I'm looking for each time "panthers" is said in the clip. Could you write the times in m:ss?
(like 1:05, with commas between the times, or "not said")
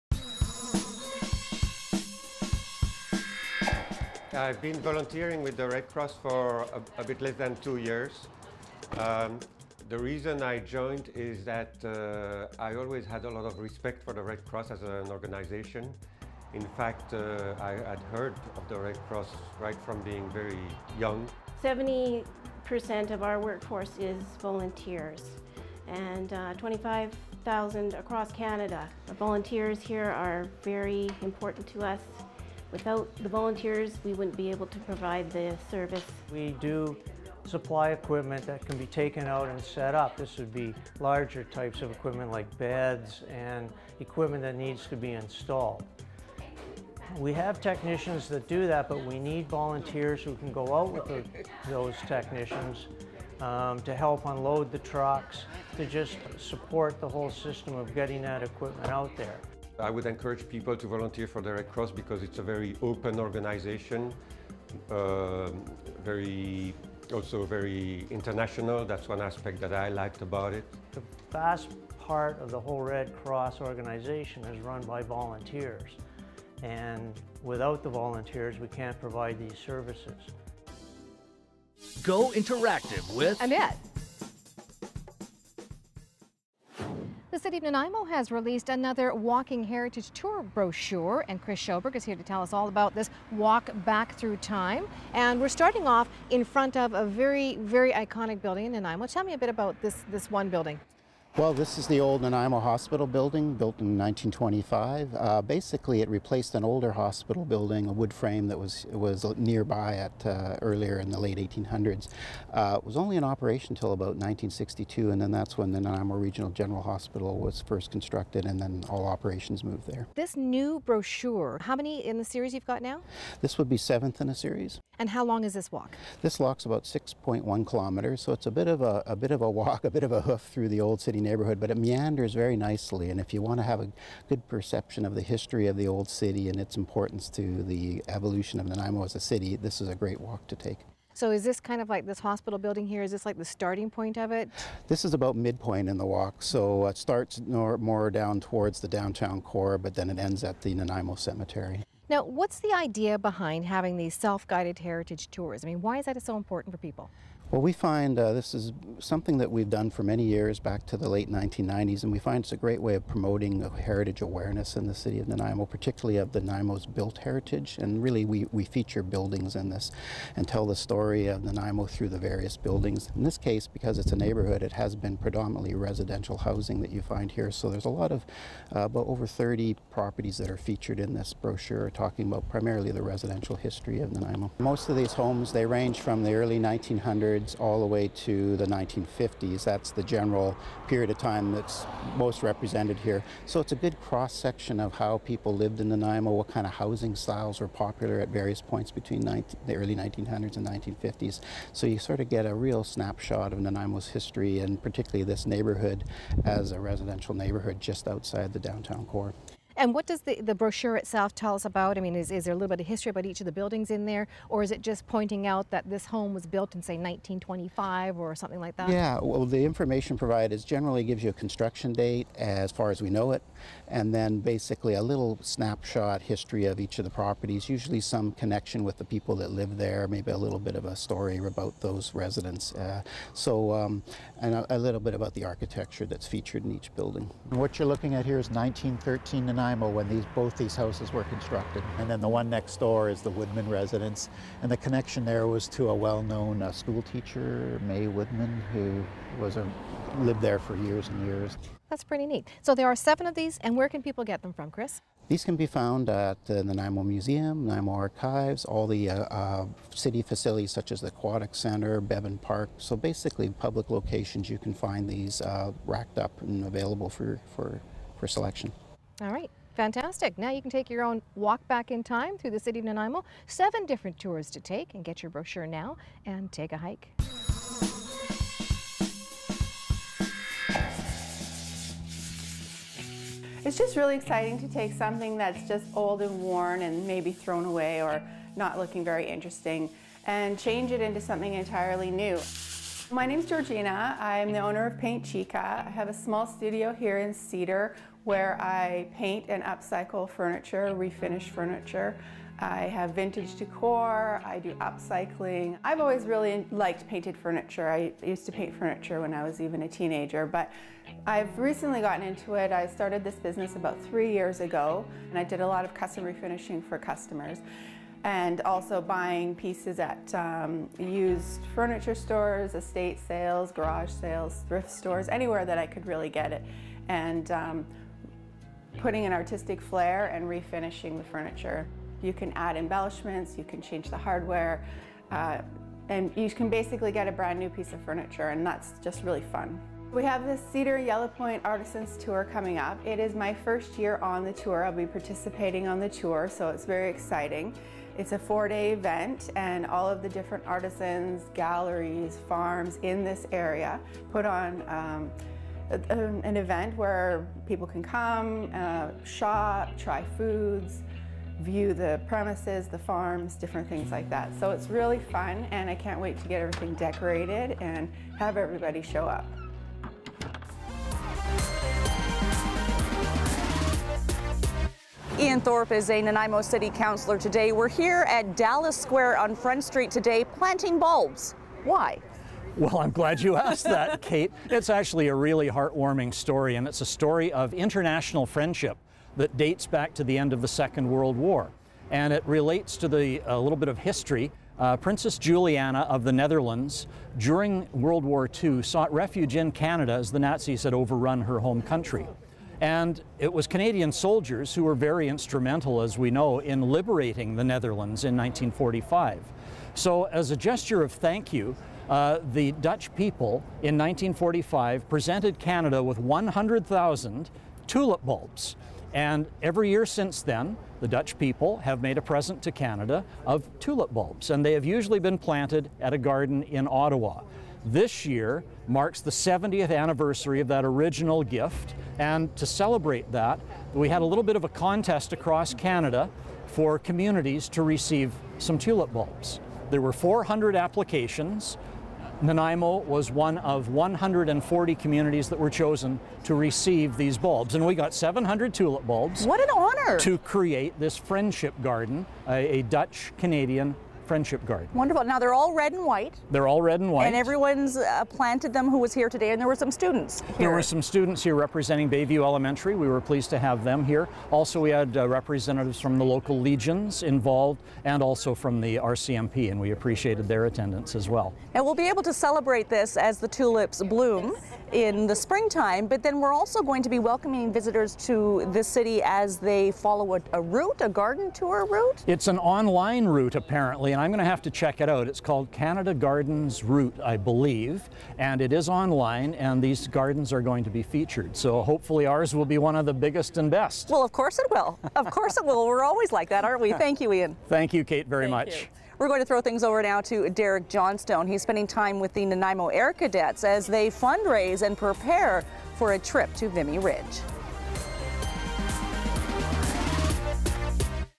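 not said.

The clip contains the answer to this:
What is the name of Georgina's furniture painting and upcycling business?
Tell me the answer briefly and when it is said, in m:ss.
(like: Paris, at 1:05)
Paint Chica, at 4:54.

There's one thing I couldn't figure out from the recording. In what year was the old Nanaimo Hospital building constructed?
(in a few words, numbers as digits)
1925.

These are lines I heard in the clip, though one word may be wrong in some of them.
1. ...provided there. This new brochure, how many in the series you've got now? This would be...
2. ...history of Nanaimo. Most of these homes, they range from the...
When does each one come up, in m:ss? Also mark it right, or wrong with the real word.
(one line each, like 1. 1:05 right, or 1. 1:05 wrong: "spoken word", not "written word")
1. 1:59 wrong: "moved", not "provided"
2. 3:03 right.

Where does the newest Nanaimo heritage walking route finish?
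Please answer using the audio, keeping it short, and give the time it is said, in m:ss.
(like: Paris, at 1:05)
Nanaimo Cemetery, at 2:30.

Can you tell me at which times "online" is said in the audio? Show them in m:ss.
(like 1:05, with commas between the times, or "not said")
8:02, 8:08.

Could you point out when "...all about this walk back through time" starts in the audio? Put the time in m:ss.
1:32.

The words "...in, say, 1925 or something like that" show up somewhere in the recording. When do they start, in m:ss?
3:36.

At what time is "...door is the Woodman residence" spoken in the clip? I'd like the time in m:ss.
4:02.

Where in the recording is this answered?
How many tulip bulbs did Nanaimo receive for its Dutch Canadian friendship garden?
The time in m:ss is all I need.
7:28.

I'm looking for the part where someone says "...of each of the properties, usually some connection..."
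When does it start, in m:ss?
3:46.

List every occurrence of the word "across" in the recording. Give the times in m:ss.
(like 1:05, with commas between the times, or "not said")
0:27, 7:15.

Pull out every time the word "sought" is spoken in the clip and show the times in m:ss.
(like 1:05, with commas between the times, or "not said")
6:38.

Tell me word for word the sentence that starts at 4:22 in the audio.
So basically public locations you can find these uh, racked up and available for, for, for selection.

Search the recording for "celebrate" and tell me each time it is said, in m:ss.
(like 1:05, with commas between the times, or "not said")
7:12, 7:52.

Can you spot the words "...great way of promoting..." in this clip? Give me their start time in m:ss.
2:42.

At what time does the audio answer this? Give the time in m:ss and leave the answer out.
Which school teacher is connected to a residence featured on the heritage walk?
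4:07.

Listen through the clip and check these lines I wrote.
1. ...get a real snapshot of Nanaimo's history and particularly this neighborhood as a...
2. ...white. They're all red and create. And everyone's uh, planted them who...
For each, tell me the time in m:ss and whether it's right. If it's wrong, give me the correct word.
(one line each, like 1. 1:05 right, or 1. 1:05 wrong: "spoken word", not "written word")
1. 3:22 right
2. 7:36 wrong: "white", not "create".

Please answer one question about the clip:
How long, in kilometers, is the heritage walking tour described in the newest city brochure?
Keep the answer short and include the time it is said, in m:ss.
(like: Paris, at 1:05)
6.1 kilometers, at 2:06.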